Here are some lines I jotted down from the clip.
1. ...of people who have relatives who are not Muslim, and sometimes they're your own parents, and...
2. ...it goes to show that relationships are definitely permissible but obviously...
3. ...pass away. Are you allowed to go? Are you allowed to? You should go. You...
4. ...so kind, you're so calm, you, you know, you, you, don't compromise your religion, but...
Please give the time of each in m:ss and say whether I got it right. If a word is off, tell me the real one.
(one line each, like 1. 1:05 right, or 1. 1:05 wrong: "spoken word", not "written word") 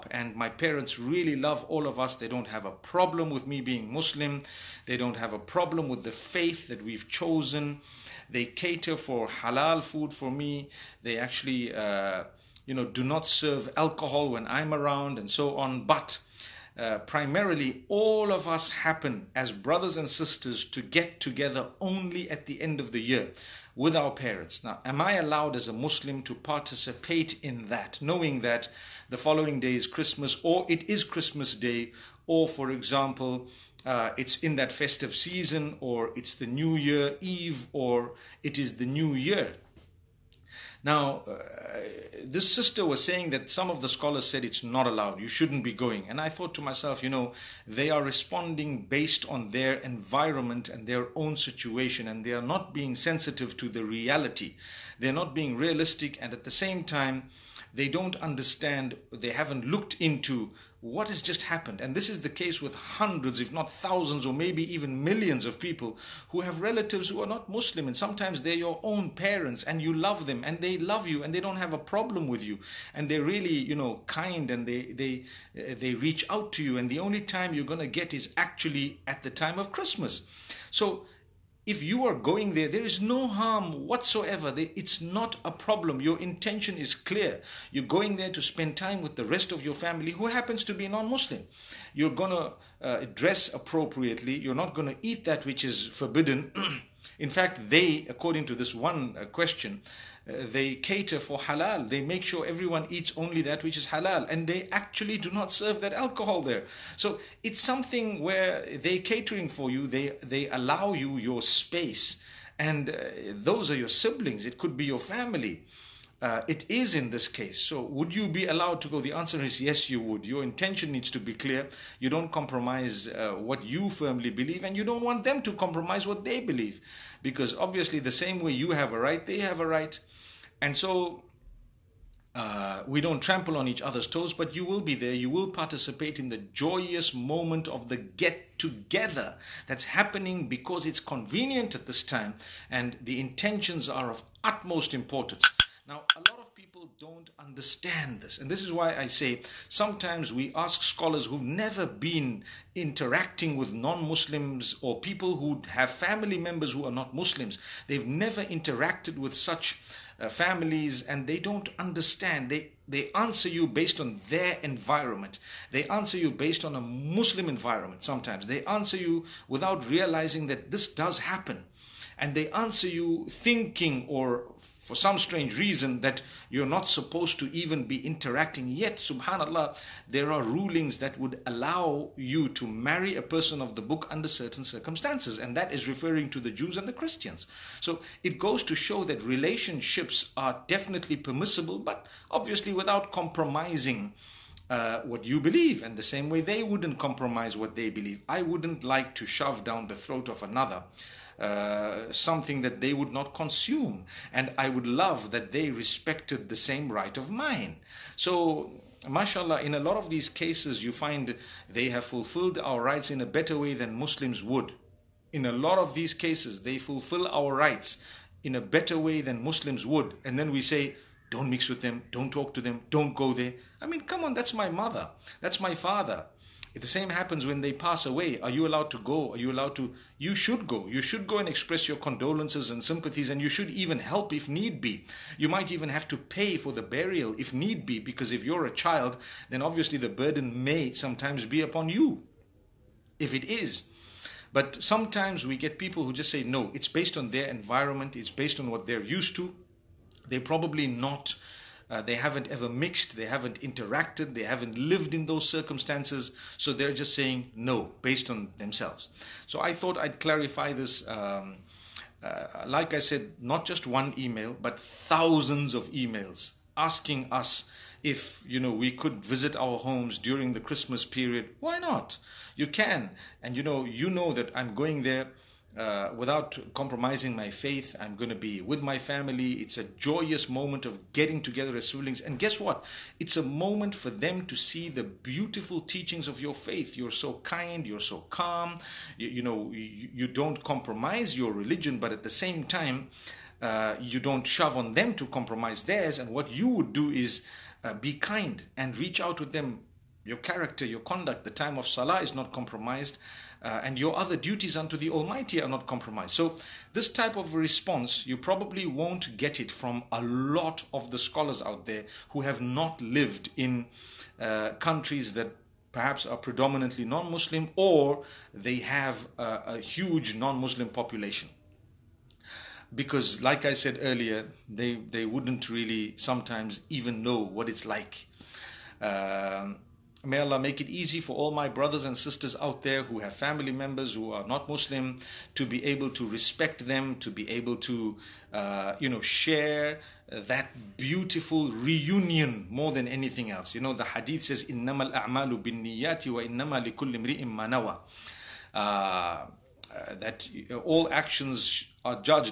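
1. 1:05 right
2. 3:08 right
3. 3:47 right
4. 4:47 right.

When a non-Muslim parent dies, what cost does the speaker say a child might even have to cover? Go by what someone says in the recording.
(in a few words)
The burial.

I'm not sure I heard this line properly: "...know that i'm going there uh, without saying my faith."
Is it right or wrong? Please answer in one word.
wrong.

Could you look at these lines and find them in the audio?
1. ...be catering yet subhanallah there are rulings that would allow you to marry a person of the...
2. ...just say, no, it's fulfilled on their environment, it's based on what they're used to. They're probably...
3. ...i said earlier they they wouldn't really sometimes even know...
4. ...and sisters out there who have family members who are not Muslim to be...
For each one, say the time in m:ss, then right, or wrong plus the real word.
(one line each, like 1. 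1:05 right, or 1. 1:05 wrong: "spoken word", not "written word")
1. 2:57 wrong: "interacting", not "catering"
2. 4:06 wrong: "based", not "fulfilled"
3. 5:23 right
4. 5:32 right.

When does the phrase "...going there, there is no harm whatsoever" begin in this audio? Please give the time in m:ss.
1:22.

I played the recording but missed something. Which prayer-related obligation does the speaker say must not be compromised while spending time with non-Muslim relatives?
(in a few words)
The time of salah.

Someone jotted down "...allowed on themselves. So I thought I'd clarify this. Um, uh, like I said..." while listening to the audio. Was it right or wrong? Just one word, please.
wrong.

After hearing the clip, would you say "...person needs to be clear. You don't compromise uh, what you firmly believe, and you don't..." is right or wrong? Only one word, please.
wrong.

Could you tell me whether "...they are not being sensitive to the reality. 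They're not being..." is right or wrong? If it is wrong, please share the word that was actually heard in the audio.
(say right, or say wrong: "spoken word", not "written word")
right.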